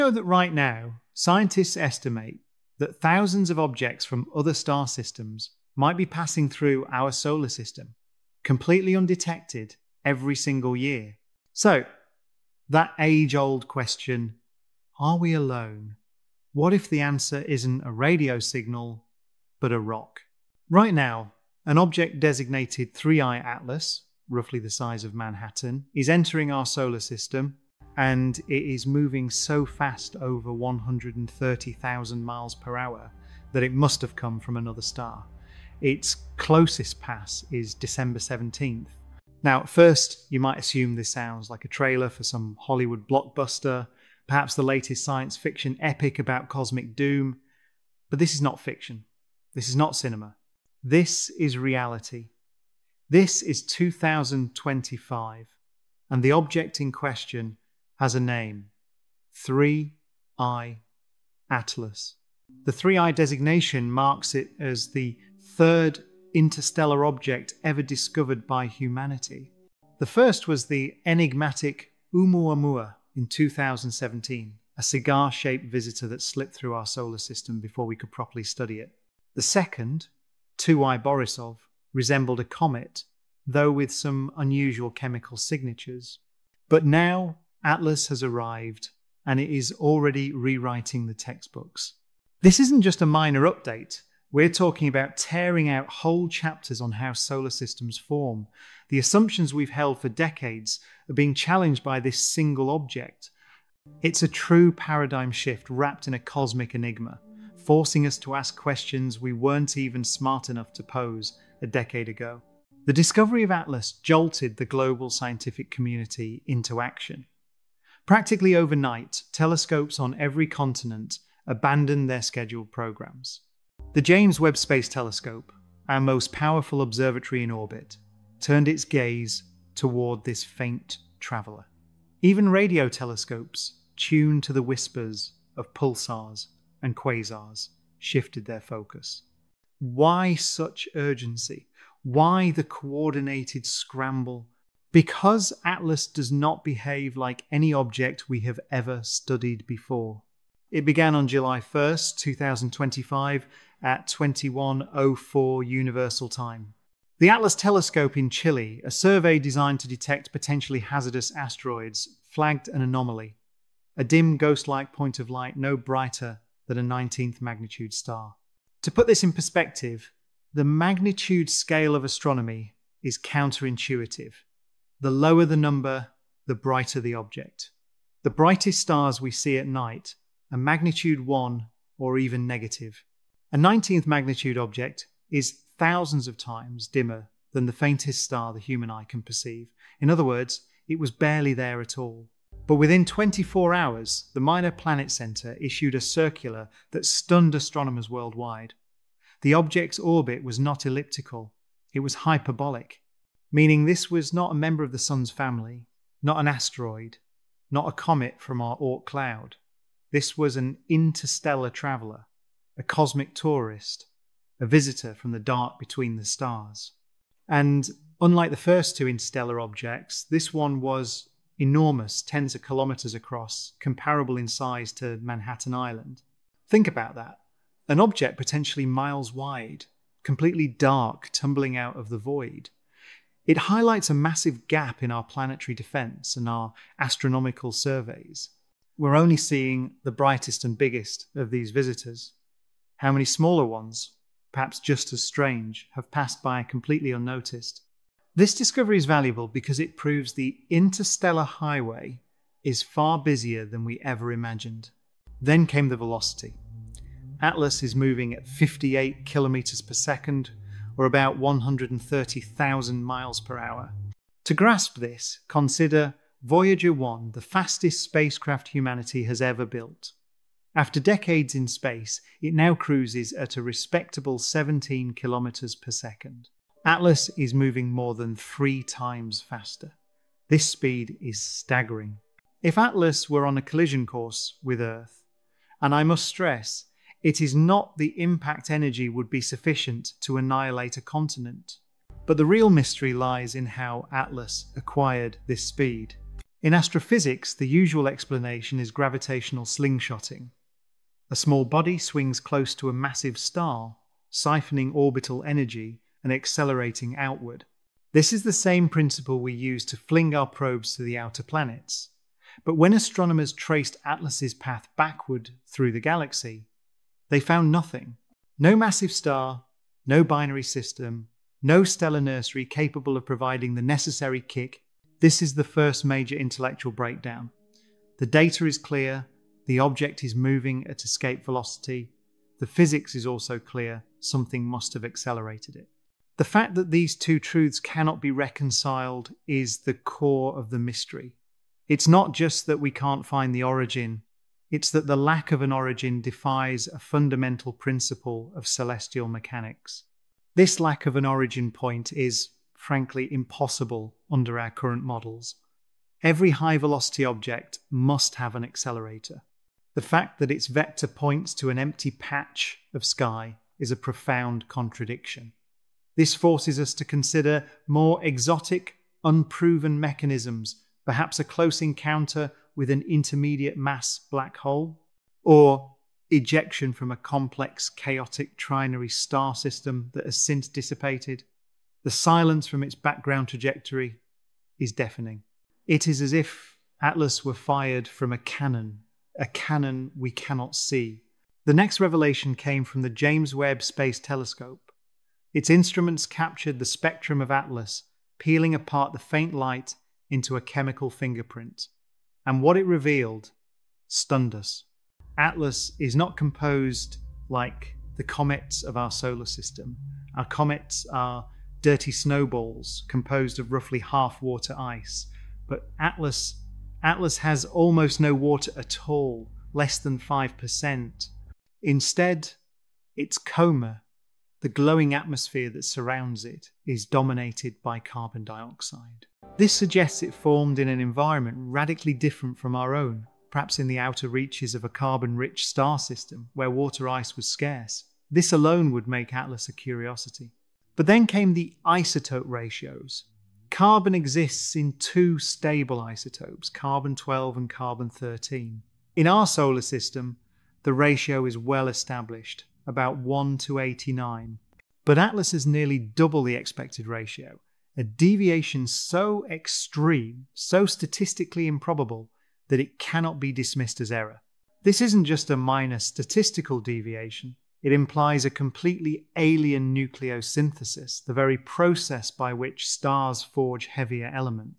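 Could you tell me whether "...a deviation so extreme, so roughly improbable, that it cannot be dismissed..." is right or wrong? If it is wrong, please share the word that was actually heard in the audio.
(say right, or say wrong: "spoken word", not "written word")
wrong: "statistically", not "roughly".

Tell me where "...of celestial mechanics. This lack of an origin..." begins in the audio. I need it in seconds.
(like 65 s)
348 s.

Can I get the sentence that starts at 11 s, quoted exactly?
So, that age old question are we alone?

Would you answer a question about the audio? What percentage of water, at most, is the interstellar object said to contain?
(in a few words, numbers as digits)
5%.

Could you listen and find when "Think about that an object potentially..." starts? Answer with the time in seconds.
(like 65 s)
226 s.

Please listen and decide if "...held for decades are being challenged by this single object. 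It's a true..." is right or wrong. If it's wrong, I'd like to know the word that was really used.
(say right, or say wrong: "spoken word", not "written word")
right.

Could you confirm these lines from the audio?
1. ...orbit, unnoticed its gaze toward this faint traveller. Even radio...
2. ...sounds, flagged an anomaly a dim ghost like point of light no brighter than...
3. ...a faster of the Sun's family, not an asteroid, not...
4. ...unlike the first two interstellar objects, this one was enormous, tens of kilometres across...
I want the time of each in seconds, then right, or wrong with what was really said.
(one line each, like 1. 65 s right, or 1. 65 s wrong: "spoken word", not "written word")
1. 127 s wrong: "turned", not "unnoticed"
2. 161 s wrong: "asteroids", not "sounds"
3. 204 s wrong: "member", not "faster"
4. 218 s right.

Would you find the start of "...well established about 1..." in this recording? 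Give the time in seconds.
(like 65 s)
451 s.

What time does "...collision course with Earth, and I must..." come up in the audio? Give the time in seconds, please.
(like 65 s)
283 s.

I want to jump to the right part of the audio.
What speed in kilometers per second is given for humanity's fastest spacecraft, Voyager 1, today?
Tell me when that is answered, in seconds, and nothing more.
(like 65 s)
274 s.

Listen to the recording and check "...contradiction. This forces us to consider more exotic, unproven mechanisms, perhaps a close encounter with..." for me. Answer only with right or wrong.
right.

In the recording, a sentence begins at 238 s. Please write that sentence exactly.
We're only seeing the brightest and biggest of these visitors.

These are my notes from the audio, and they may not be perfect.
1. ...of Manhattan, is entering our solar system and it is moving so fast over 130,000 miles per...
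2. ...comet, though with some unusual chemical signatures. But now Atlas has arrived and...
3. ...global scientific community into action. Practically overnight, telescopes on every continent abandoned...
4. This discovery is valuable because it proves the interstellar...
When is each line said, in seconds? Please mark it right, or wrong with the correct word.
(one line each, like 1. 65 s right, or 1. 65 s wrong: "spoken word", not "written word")
1. 25 s right
2. 82 s right
3. 114 s right
4. 248 s right.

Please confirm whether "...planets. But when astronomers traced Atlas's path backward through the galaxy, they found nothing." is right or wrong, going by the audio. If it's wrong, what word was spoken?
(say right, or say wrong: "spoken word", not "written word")
right.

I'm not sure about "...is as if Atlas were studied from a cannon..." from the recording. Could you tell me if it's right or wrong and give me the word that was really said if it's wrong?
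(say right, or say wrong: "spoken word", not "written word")
wrong: "fired", not "studied".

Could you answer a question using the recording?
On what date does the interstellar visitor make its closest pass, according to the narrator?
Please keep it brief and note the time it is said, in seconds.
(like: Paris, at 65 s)
December 17th, at 37 s.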